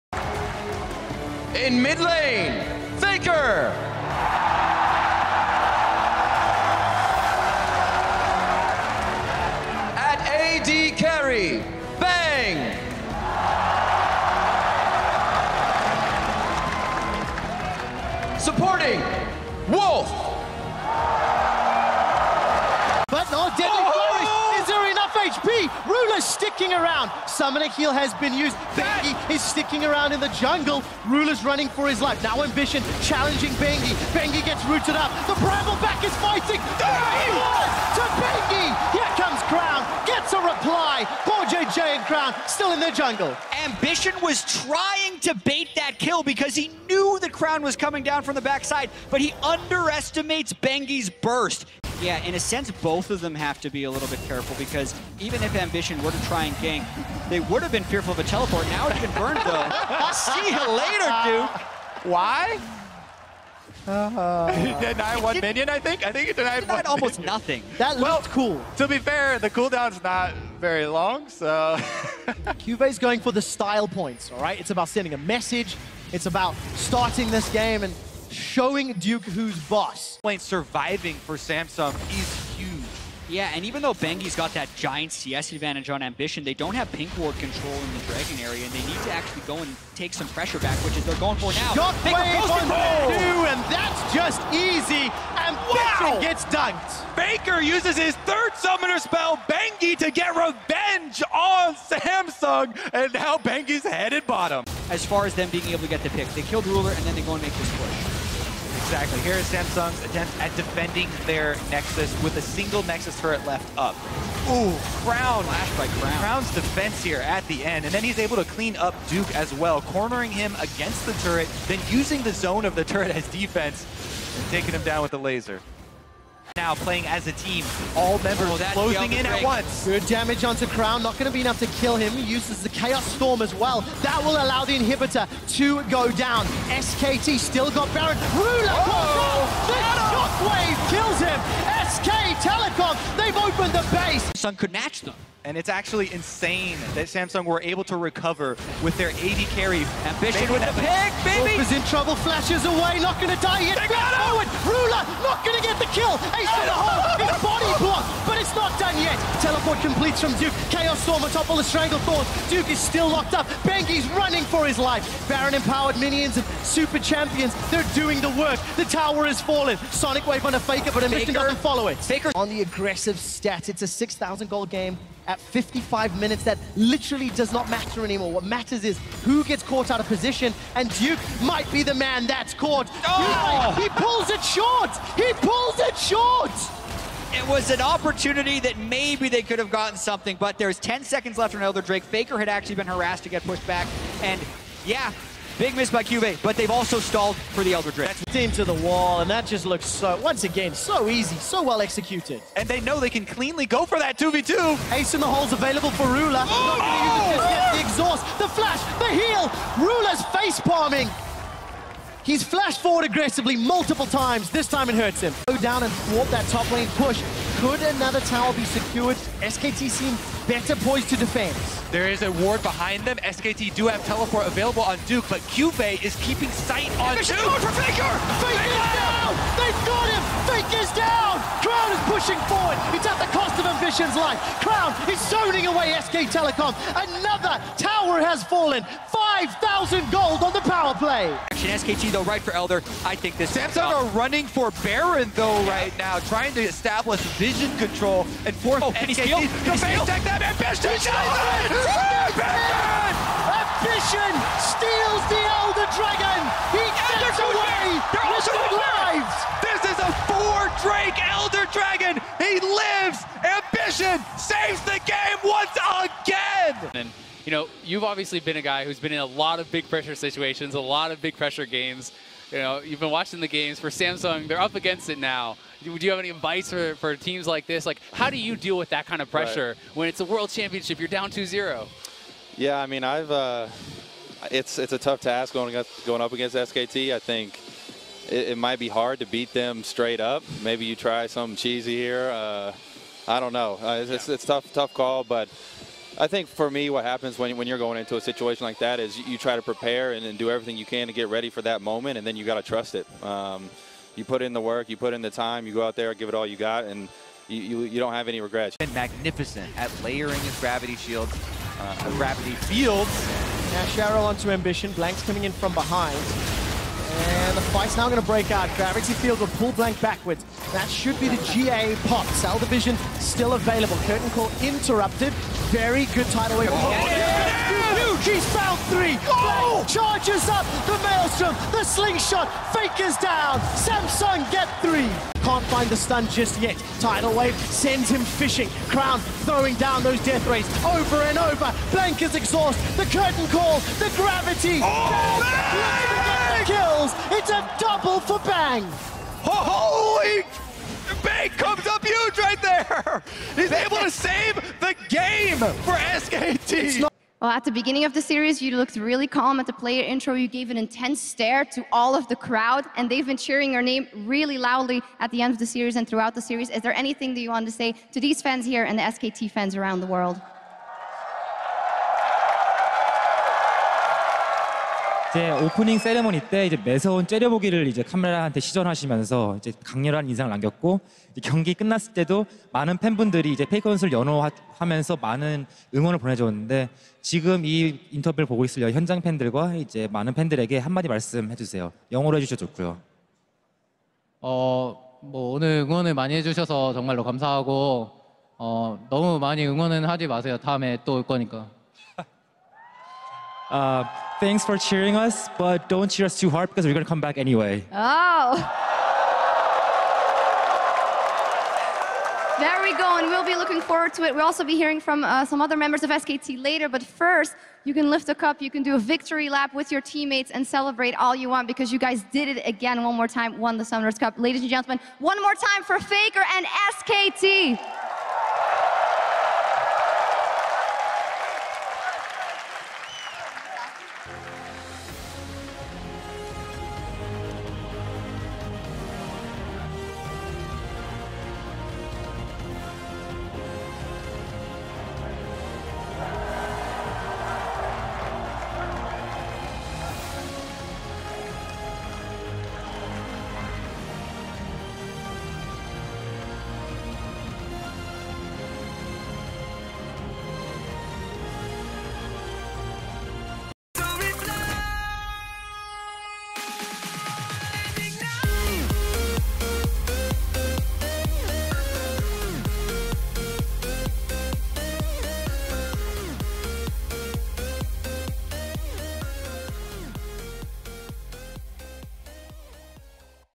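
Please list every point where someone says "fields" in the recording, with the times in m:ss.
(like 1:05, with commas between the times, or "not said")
5:12, 5:19.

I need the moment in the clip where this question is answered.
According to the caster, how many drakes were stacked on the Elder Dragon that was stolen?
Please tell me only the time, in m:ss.
4:20.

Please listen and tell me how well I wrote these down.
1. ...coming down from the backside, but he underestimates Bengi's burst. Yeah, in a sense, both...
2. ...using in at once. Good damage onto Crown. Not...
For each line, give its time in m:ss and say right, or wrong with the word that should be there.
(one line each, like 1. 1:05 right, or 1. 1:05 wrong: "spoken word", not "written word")
1. 0:47 right
2. 2:08 wrong: "closing", not "using".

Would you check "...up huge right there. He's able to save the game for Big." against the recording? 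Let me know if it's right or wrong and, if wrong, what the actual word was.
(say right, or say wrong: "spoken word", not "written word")
wrong: "SKT", not "Big".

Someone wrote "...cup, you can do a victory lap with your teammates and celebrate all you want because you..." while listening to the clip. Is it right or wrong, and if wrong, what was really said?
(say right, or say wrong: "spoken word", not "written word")
right.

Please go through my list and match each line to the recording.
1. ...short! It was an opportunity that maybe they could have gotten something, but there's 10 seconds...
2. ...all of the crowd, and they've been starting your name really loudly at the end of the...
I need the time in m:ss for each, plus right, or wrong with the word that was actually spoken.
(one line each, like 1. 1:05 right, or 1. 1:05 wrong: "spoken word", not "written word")
1. 3:05 right
2. 6:01 wrong: "cheering", not "starting".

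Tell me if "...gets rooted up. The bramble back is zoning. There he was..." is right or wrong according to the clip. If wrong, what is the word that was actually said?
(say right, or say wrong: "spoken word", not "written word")
wrong: "fighting", not "zoning".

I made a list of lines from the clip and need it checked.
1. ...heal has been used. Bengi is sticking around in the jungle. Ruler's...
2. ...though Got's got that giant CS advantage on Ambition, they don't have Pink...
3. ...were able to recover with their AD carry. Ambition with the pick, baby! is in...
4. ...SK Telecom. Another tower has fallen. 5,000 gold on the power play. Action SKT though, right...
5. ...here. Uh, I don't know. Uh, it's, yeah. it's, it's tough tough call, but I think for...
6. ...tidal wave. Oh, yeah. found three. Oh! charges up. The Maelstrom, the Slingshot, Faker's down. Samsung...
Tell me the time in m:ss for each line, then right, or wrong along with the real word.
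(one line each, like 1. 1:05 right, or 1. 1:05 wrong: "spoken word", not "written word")
1. 0:27 right
2. 1:23 wrong: "Bengi", not "Got"
3. 2:27 right
4. 3:56 right
5. 4:51 right
6. 5:26 right.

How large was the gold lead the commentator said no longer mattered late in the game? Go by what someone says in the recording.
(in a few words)
6,000.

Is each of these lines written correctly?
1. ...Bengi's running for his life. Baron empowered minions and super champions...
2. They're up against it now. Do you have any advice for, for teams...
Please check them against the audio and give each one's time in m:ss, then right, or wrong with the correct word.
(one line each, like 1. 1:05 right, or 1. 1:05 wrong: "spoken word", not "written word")
1. 2:43 right
2. 4:34 right.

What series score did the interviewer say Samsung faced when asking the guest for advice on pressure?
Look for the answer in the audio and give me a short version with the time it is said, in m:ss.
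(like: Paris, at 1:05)
2-0, at 4:41.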